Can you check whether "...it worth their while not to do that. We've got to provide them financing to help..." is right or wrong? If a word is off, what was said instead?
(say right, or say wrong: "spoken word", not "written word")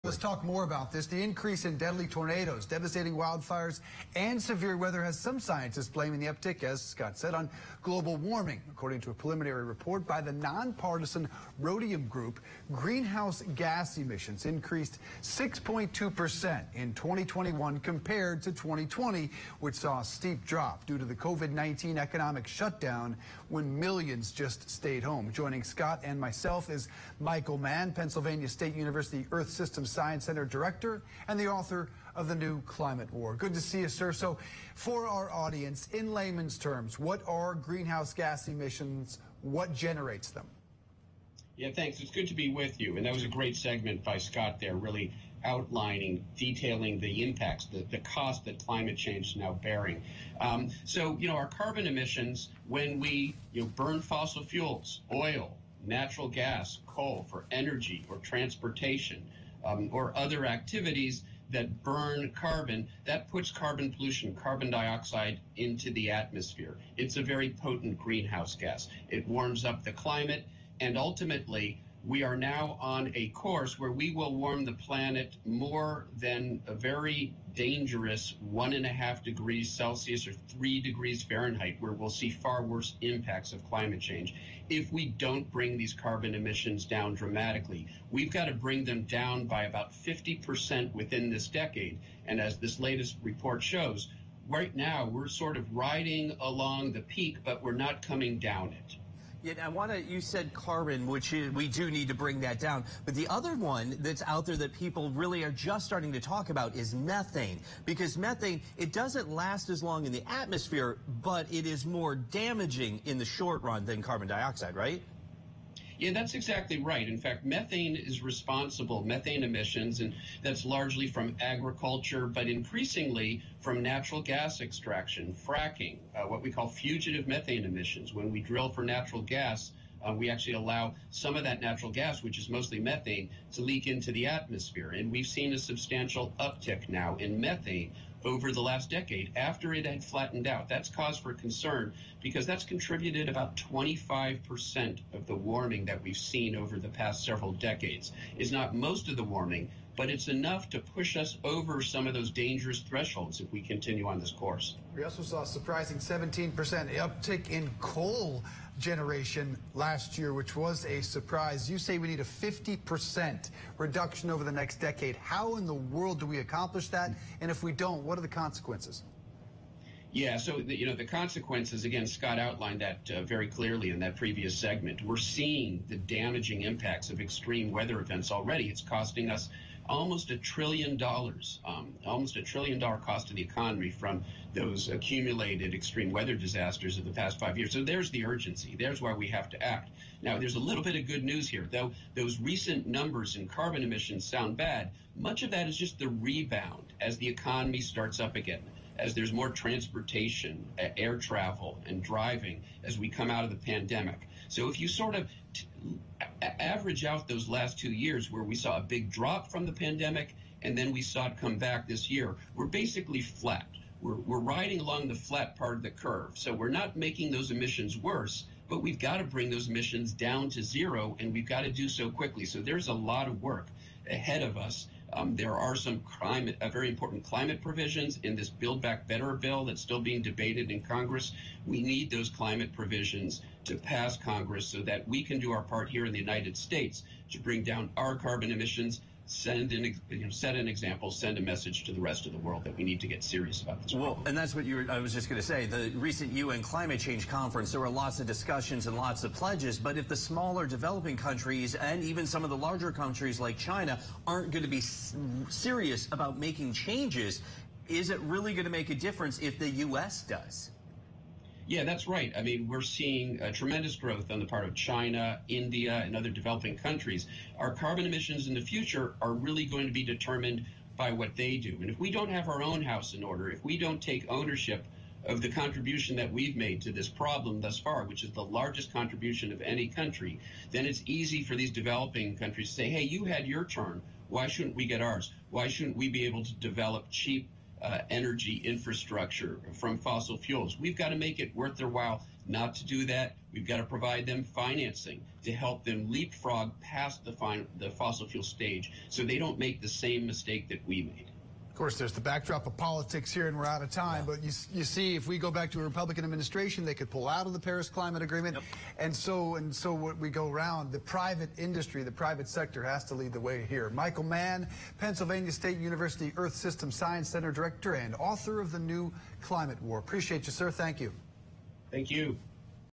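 right.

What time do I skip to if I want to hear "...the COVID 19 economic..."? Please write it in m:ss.
0:21.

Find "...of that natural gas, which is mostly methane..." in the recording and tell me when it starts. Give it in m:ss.
2:11.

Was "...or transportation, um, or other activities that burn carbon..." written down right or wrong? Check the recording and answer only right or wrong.
right.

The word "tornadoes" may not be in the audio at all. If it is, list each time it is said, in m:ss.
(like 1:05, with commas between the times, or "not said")
0:02.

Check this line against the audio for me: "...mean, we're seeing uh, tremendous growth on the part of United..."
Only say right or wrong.
wrong.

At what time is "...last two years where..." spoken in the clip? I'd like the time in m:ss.
3:27.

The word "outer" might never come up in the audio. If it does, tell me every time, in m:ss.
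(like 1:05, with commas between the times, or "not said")
not said.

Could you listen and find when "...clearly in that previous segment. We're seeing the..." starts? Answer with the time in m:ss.
2:53.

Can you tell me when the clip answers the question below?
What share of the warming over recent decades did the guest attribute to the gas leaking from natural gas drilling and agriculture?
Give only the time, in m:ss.
2:23.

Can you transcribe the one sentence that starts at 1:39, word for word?
Yeah, I want to, you said carbon, which is, we do need to bring that down.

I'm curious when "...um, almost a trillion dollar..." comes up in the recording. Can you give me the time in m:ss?
3:01.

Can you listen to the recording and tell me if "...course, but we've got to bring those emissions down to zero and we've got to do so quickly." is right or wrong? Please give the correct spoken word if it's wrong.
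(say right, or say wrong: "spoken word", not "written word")
wrong: "worse", not "course".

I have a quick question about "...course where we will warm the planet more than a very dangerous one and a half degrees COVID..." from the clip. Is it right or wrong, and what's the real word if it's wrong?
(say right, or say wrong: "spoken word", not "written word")
wrong: "Celsius", not "COVID".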